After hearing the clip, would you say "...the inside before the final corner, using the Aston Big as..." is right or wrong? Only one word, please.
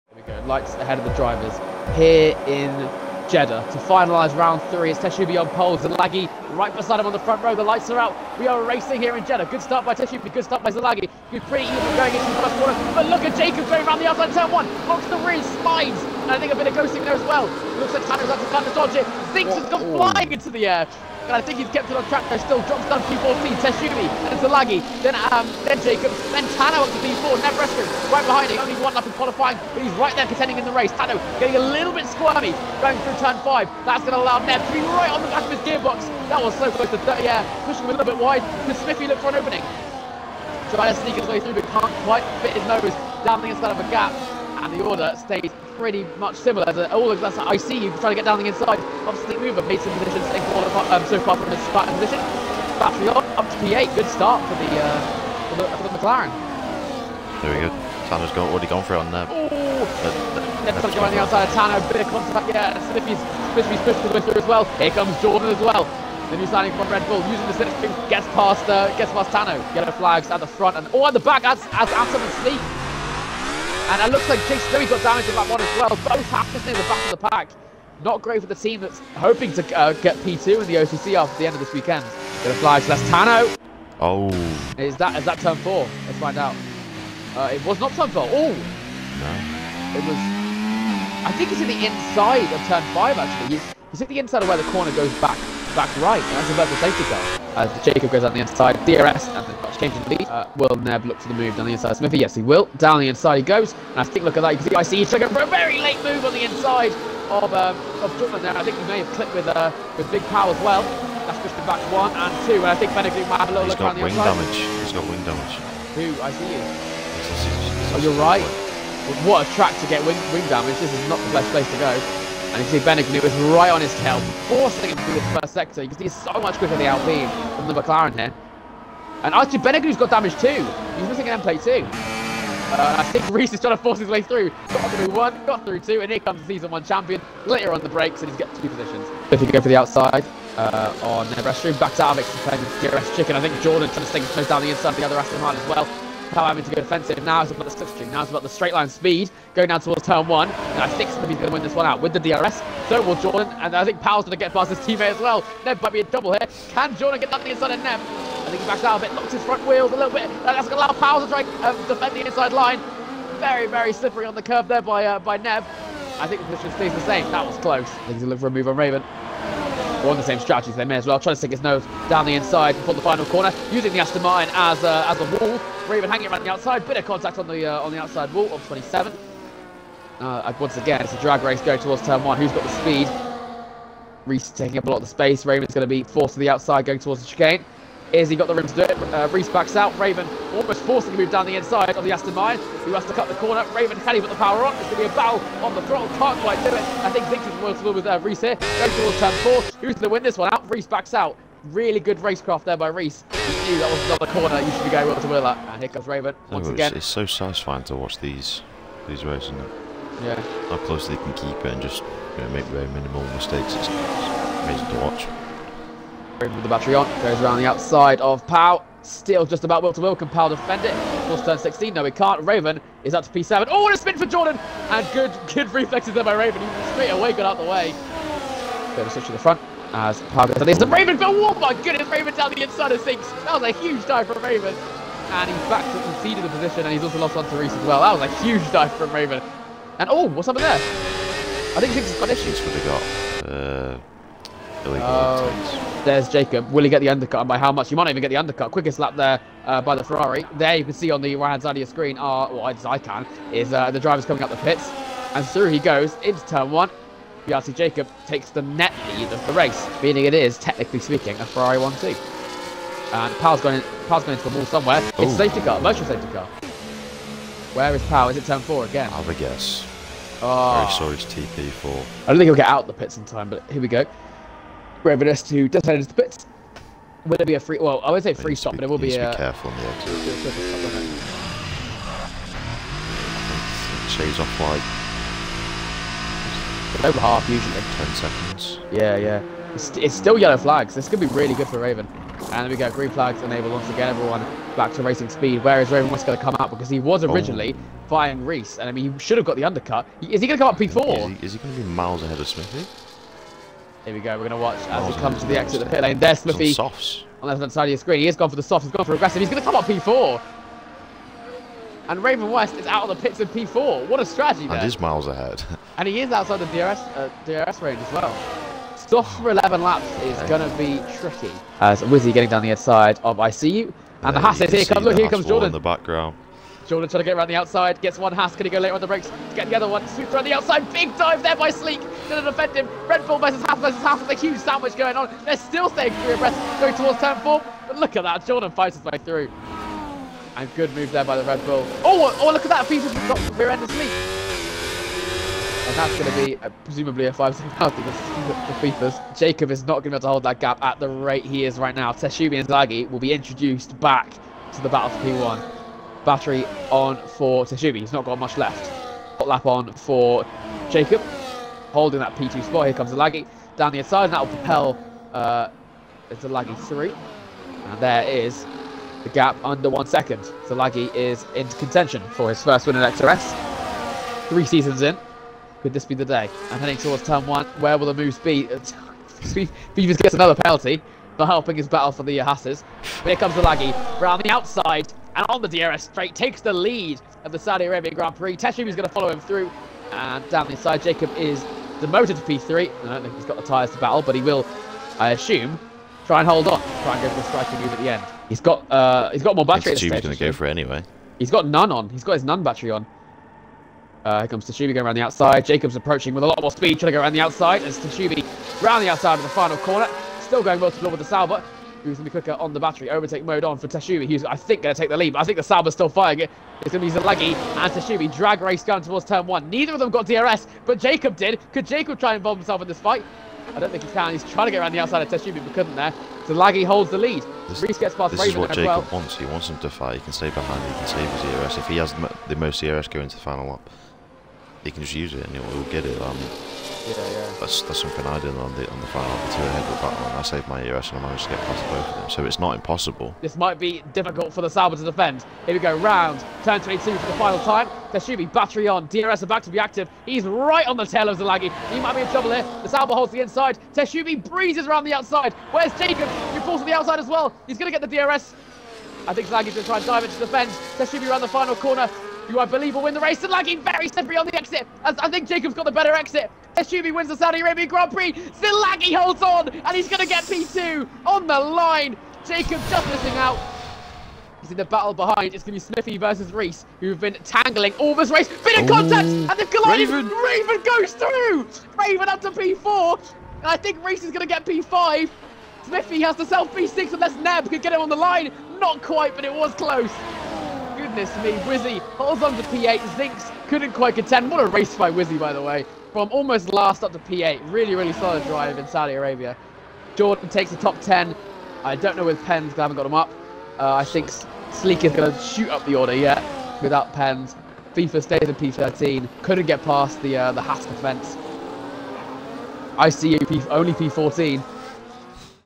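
wrong.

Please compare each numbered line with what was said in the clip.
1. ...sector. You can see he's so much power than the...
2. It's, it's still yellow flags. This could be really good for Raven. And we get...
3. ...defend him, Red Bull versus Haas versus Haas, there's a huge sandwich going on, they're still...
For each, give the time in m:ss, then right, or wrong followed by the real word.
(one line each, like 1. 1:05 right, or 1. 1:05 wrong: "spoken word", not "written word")
1. 2:05 wrong: "quicker", not "power"
2. 4:49 right
3. 5:32 right.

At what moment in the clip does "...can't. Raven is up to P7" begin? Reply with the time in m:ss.
3:42.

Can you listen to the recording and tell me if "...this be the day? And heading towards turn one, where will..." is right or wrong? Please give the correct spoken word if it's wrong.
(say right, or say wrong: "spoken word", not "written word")
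right.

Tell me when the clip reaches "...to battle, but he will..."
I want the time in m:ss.
6:33.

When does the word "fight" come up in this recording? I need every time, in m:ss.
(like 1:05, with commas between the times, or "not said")
5:38, 7:03, 7:09.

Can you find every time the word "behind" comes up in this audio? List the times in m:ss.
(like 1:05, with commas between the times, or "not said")
0:28, 7:10, 7:55.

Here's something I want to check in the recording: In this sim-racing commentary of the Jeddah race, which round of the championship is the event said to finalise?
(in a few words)
Round three.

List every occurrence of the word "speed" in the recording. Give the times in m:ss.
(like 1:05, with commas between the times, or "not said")
2:28, 3:02, 4:55, 6:46.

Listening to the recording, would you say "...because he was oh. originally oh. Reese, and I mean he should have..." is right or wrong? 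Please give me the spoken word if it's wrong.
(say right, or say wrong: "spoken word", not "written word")
right.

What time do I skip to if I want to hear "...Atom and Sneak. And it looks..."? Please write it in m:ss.
1:11.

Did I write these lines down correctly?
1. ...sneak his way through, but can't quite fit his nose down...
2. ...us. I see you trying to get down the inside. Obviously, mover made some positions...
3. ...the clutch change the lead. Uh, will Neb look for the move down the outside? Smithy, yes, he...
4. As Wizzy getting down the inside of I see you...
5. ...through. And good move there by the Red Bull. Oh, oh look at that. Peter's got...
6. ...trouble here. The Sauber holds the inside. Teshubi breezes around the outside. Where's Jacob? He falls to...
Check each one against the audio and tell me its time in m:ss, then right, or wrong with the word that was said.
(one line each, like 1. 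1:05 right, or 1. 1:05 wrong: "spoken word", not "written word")
1. 0:41 right
2. 0:47 right
3. 1:39 wrong: "inside", not "outside"
4. 5:21 right
5. 5:39 right
6. 7:32 right.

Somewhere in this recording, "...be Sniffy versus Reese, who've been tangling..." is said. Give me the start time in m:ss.
7:55.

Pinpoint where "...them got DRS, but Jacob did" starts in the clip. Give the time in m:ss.
6:59.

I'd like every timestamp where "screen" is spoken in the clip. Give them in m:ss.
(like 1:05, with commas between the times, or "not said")
4:11, 5:07.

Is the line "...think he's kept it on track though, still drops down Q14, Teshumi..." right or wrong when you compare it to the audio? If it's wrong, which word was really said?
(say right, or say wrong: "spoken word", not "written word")
right.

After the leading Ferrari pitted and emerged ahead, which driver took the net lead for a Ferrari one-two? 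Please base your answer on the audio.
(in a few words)
Piazzi Jacob.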